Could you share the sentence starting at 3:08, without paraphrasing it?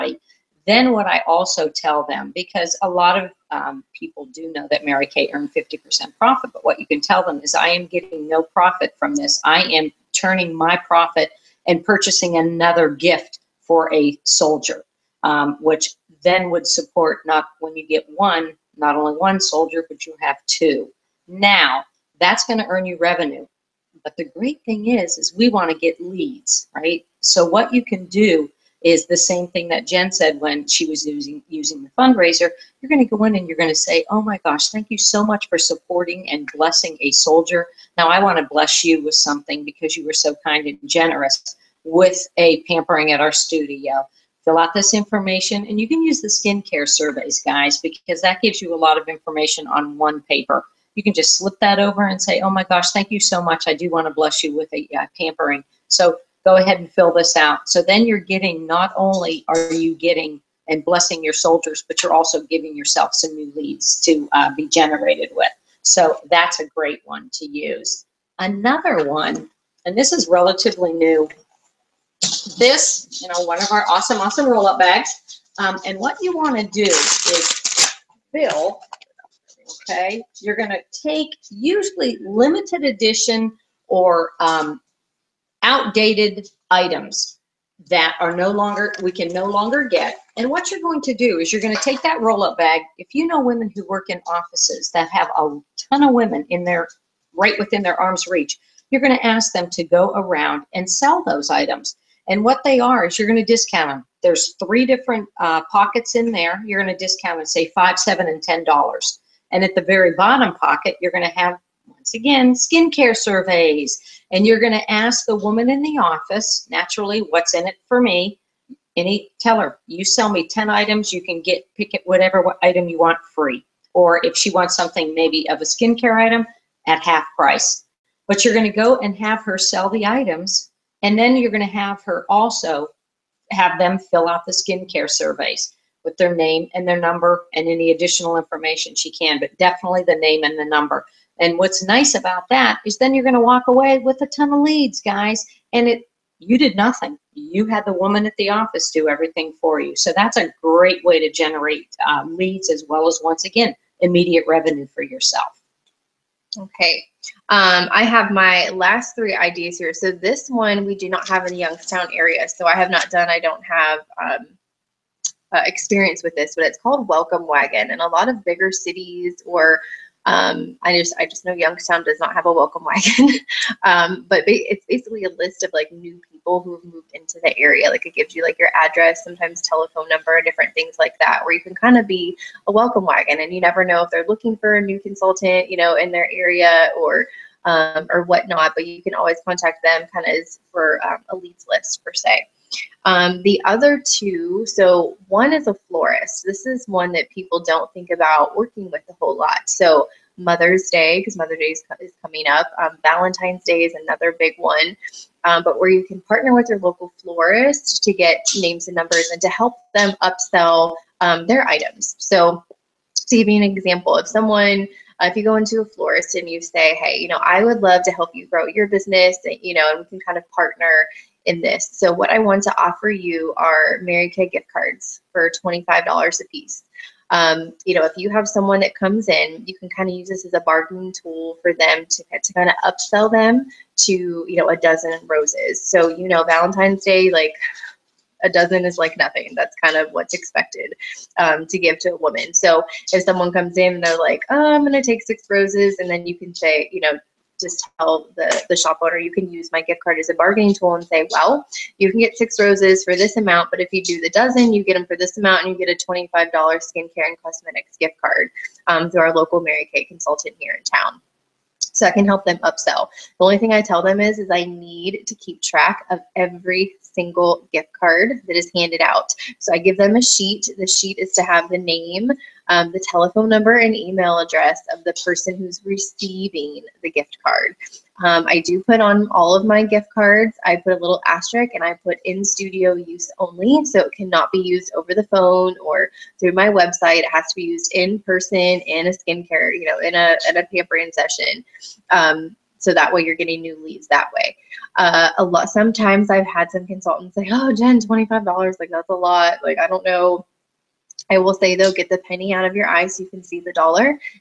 But you can always contact them, kind of for um, a leads list per se.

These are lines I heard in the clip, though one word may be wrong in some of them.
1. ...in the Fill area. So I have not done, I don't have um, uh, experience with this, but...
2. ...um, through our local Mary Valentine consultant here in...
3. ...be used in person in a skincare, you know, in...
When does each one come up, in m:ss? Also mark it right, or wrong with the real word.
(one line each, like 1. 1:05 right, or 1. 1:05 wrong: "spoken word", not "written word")
1. 2:41 wrong: "Youngstown", not "Fill"
2. 4:18 wrong: "Kay", not "Valentine"
3. 4:47 right.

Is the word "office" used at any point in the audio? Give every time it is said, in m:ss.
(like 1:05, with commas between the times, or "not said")
1:34, 1:55, 2:28.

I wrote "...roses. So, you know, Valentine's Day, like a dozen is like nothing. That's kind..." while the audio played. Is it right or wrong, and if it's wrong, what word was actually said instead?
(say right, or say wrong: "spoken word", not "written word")
right.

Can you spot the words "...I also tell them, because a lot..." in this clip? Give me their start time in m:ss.
0:01.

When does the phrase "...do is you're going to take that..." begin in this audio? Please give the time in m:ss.
1:31.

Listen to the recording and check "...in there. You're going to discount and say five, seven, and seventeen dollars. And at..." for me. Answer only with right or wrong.
wrong.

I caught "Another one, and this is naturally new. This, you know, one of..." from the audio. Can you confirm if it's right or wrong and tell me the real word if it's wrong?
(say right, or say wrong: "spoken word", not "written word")
wrong: "relatively", not "naturally".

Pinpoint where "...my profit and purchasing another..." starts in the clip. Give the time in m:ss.
0:10.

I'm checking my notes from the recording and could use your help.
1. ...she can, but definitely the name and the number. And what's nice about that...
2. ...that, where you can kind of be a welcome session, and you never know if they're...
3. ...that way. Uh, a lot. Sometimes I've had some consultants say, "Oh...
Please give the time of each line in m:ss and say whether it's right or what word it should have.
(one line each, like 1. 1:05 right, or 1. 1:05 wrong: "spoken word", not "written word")
1. 2:18 right
2. 3:01 wrong: "wagon", not "session"
3. 4:54 right.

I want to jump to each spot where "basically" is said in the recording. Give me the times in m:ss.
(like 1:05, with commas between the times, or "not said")
2:54.